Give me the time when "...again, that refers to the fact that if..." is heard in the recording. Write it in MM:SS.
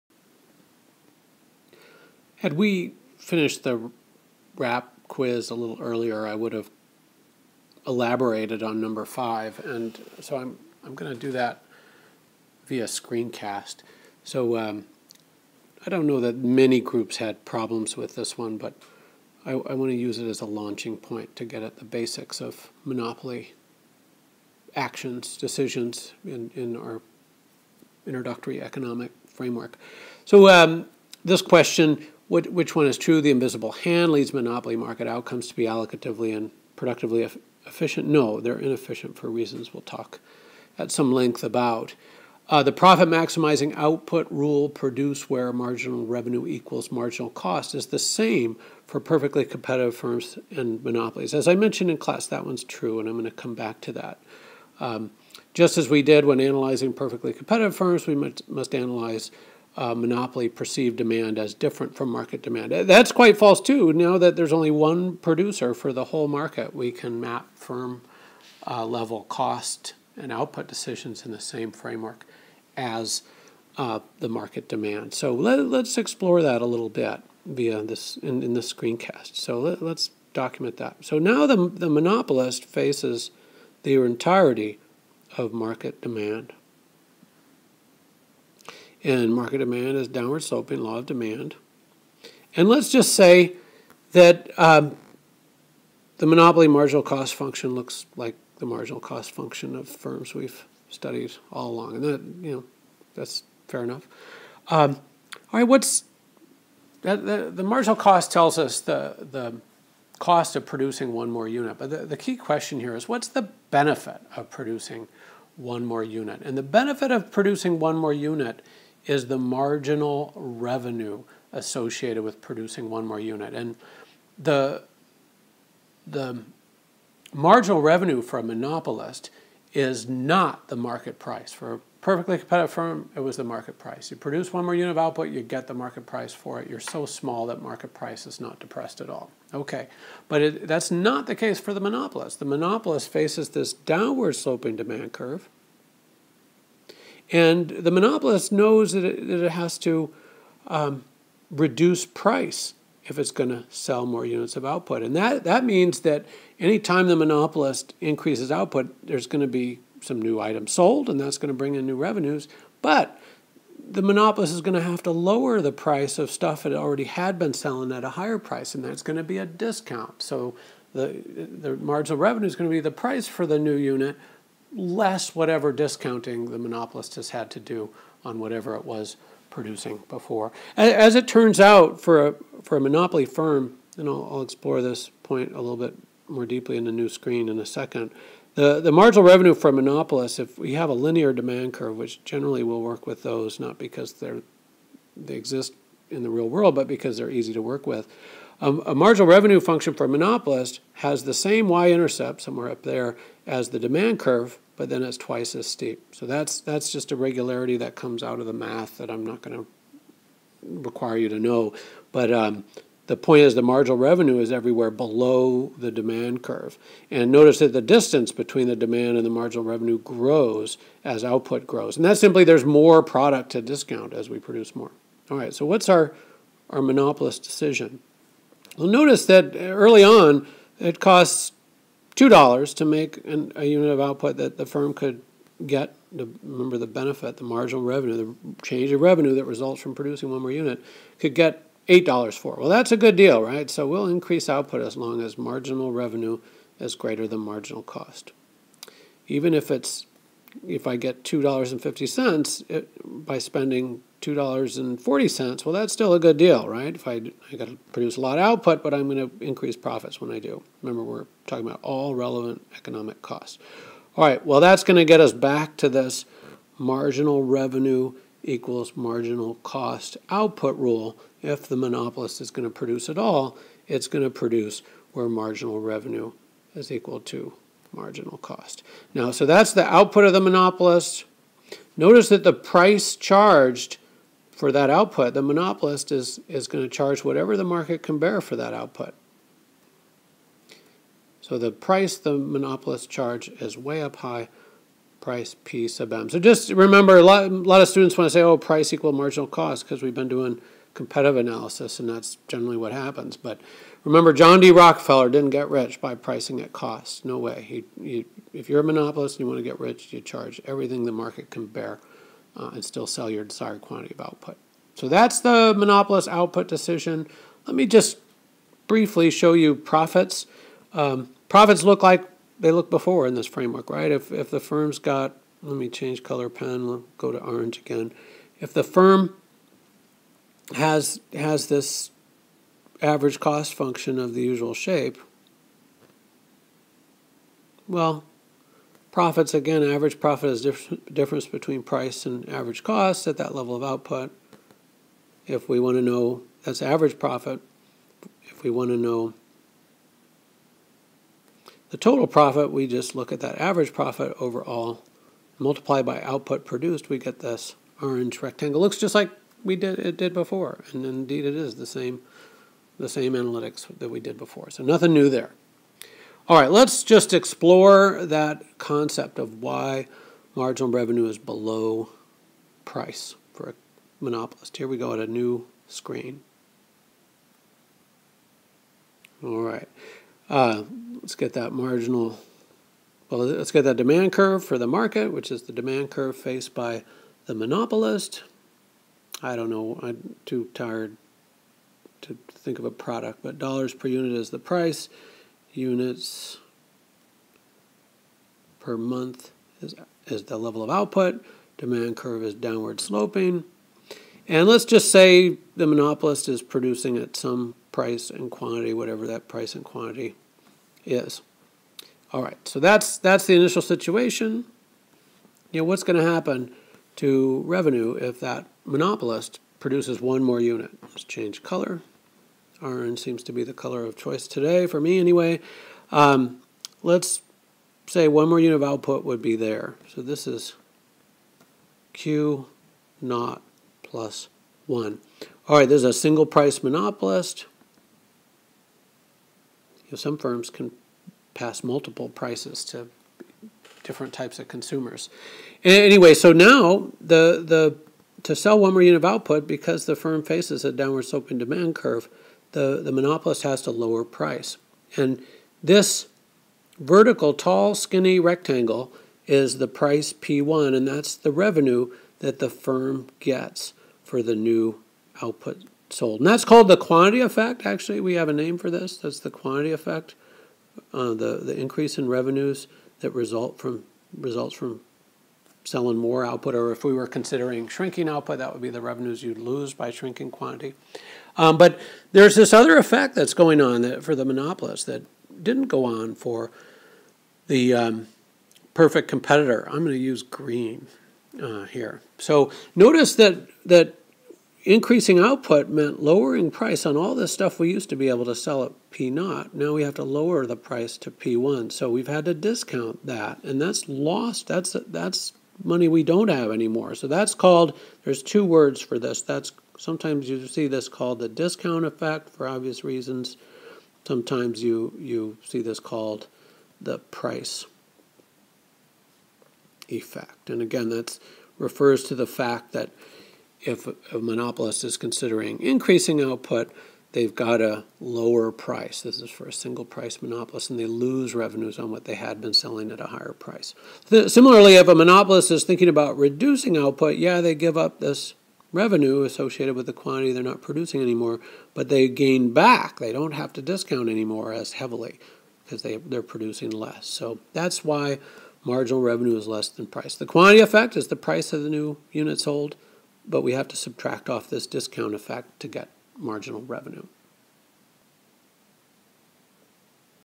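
08:40.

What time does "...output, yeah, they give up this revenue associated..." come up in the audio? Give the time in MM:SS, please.
08:56.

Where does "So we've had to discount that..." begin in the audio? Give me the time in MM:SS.
08:21.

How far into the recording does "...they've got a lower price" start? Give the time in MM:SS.
08:47.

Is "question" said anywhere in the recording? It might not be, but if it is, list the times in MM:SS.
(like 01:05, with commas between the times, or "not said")
00:31, 01:52.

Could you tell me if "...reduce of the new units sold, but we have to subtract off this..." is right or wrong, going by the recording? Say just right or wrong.
wrong.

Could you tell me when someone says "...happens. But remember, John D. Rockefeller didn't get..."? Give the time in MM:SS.
05:02.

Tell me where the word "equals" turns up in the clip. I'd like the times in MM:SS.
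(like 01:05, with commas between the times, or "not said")
00:46, 04:28, 04:36, 04:58.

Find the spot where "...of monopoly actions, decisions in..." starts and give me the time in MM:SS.
00:22.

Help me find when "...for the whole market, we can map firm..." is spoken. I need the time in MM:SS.
01:05.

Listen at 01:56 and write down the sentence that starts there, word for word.
And the benefit of producing one more unit is the marginal revenue associated with producing one more unit.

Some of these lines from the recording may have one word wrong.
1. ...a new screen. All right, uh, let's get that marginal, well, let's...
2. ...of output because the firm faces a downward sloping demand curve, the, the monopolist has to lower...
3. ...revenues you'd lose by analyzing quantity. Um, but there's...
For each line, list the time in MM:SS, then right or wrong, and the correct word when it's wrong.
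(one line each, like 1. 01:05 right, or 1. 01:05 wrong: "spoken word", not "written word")
1. 06:15 right
2. 07:29 right
3. 07:59 wrong: "shrinking", not "analyzing".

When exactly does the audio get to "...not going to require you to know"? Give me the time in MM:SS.
03:29.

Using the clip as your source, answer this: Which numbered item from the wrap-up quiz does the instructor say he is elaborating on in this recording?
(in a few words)
5.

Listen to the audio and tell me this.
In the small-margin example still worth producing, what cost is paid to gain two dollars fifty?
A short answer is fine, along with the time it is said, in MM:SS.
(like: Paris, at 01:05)
$2.40, at 04:14.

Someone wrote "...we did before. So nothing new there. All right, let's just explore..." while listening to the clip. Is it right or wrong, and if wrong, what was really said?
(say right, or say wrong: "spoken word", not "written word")
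right.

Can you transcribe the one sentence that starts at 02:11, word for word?
For a perfectly competitive firm, it was the market price.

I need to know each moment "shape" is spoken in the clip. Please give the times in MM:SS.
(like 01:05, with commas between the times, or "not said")
05:34.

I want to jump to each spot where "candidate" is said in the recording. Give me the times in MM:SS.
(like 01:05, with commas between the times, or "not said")
not said.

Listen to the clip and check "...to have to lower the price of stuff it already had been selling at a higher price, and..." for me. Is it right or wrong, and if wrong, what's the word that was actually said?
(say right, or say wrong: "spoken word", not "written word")
right.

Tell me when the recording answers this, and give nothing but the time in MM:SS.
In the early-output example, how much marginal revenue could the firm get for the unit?
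04:01.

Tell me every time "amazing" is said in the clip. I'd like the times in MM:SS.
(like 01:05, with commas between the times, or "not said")
not said.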